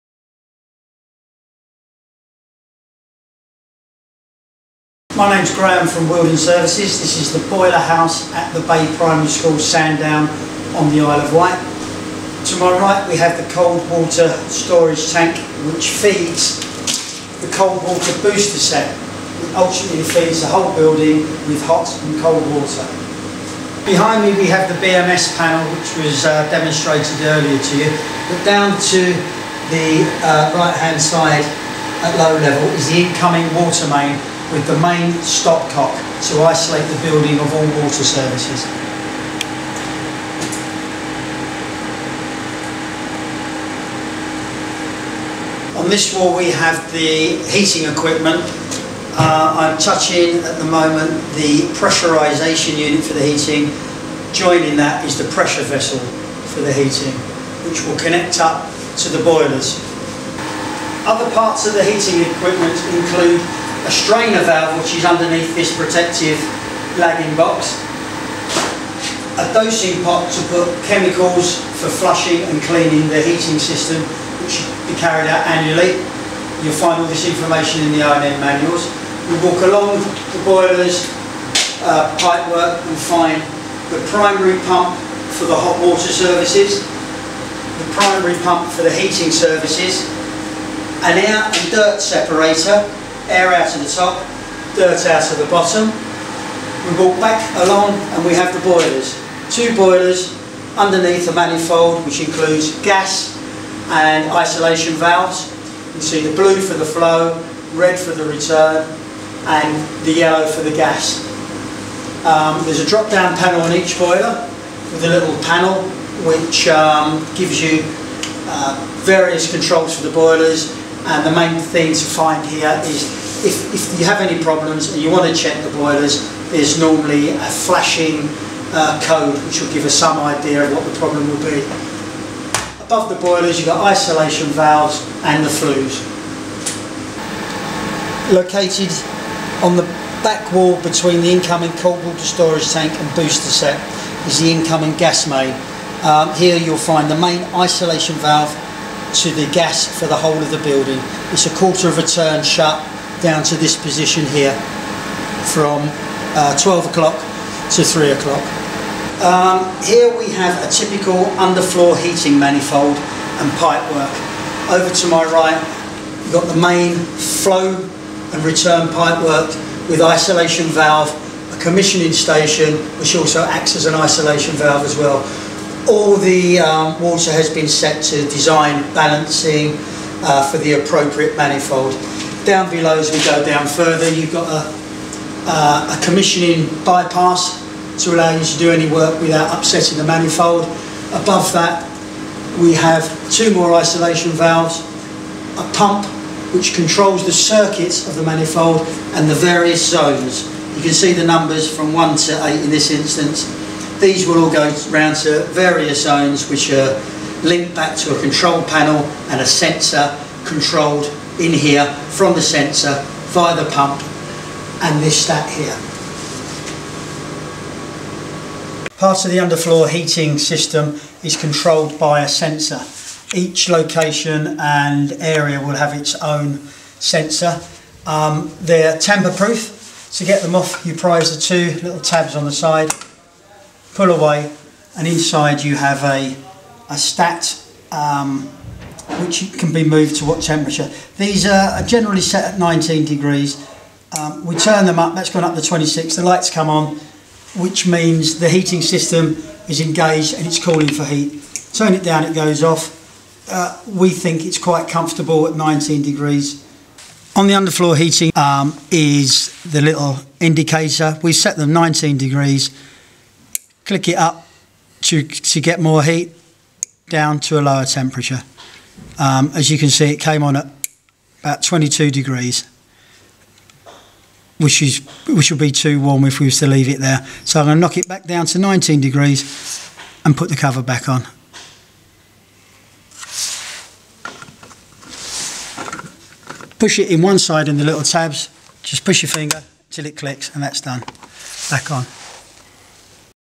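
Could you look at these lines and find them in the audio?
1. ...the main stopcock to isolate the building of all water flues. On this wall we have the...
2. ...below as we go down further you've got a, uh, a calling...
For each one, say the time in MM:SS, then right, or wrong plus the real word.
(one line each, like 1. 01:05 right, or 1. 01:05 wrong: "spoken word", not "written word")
1. 00:34 wrong: "services", not "flues"
2. 03:02 wrong: "commissioning", not "calling".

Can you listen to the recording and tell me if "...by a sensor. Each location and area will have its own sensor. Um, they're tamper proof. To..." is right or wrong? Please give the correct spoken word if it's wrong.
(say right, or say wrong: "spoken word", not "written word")
right.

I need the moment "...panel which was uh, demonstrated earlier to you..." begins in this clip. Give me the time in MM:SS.
00:25.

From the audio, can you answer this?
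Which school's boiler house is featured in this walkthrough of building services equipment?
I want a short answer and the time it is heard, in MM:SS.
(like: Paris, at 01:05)
Bay Primary School, at 00:08.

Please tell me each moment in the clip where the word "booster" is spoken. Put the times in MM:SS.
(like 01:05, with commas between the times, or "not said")
00:18, 02:23.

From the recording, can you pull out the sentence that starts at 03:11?
Above that we have two more isolation valves, a pump which controls the circuits of the manifold and the various zones.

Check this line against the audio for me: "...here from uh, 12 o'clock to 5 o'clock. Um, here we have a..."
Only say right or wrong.
wrong.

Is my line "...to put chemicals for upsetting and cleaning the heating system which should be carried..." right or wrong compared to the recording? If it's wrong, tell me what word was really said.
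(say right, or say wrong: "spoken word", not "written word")
wrong: "flushing", not "upsetting".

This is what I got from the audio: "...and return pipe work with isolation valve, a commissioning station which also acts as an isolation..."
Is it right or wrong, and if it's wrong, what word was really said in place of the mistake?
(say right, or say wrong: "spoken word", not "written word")
right.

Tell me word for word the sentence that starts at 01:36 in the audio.
We walk back along and we have the boilers.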